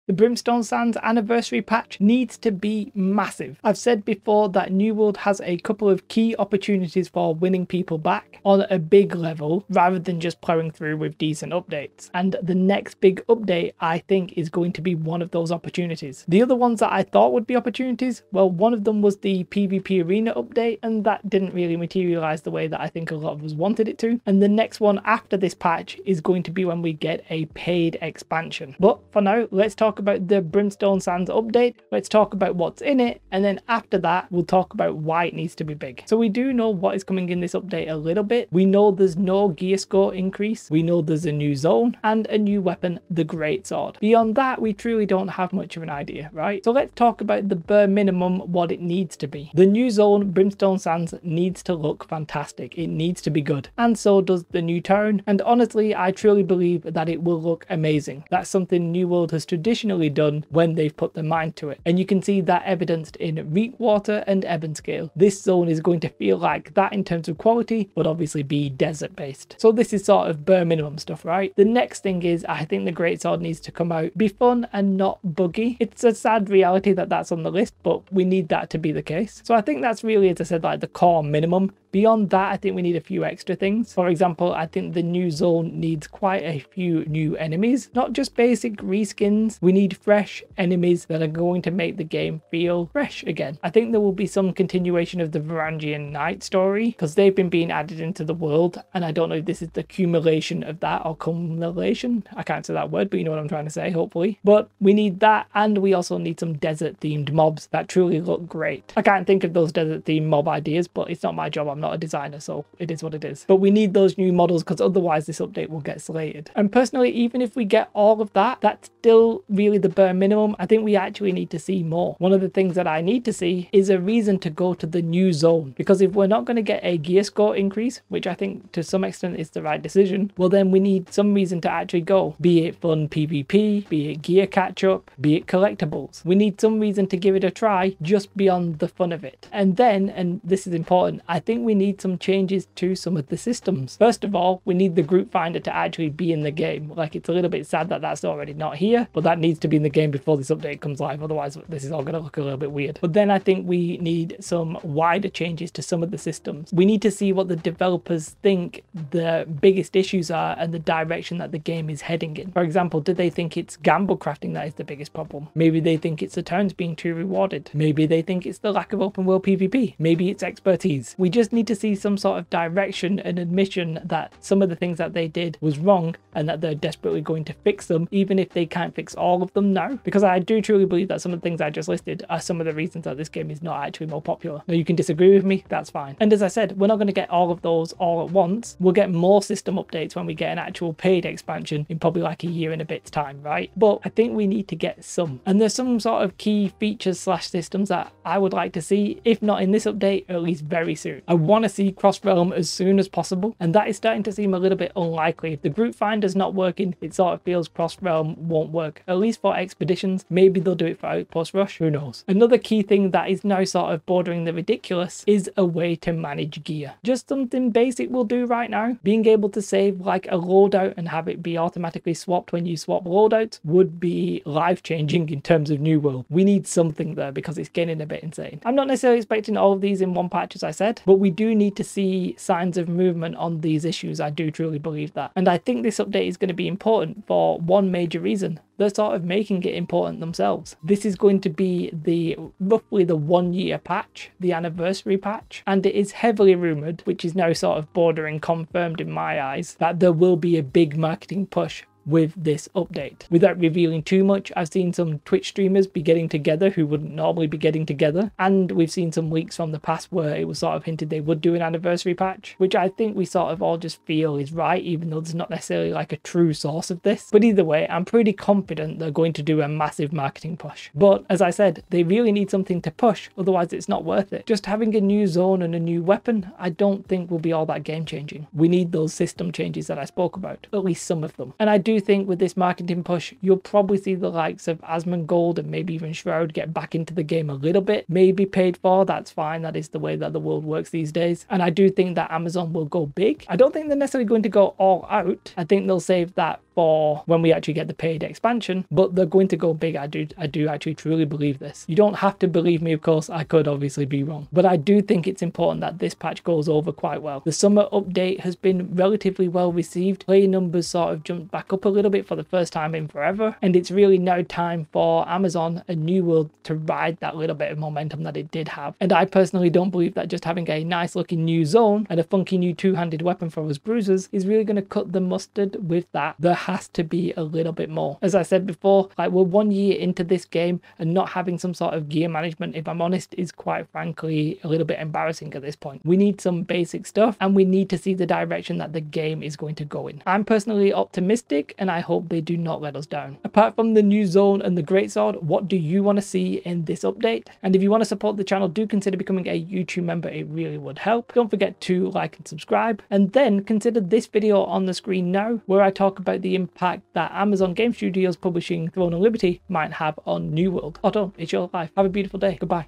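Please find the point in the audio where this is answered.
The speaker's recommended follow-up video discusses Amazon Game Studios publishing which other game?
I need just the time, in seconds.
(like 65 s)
358 s.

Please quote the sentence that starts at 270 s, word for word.
But as I said, they really need something to push, otherwise it's not worth it.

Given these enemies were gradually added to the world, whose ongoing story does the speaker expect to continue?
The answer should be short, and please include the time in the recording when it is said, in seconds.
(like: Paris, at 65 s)
Varangian Knight, at 95 s.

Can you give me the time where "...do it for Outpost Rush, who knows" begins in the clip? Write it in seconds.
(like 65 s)
210 s.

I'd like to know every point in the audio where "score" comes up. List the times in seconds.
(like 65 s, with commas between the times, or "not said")
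39 s, 127 s.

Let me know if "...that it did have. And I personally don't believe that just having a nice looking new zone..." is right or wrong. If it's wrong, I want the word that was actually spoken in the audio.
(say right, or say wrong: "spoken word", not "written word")
right.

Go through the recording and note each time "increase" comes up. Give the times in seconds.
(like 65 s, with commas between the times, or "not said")
40 s, 127 s.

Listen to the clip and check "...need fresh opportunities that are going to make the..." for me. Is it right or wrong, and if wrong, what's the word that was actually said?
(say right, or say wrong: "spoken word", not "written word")
wrong: "enemies", not "opportunities".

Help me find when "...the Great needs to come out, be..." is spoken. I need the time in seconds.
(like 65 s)
72 s.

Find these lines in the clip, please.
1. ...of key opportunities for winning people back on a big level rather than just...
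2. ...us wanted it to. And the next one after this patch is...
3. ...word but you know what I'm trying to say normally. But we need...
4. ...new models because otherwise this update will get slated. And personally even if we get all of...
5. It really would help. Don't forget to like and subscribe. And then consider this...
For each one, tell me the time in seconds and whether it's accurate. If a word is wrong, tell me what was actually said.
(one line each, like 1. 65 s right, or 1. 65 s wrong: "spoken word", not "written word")
1. 5 s right
2. 23 s right
3. 102 s wrong: "hopefully", not "normally"
4. 114 s right
5. 350 s right.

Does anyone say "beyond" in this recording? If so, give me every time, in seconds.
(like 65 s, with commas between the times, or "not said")
44 s, 81 s, 138 s.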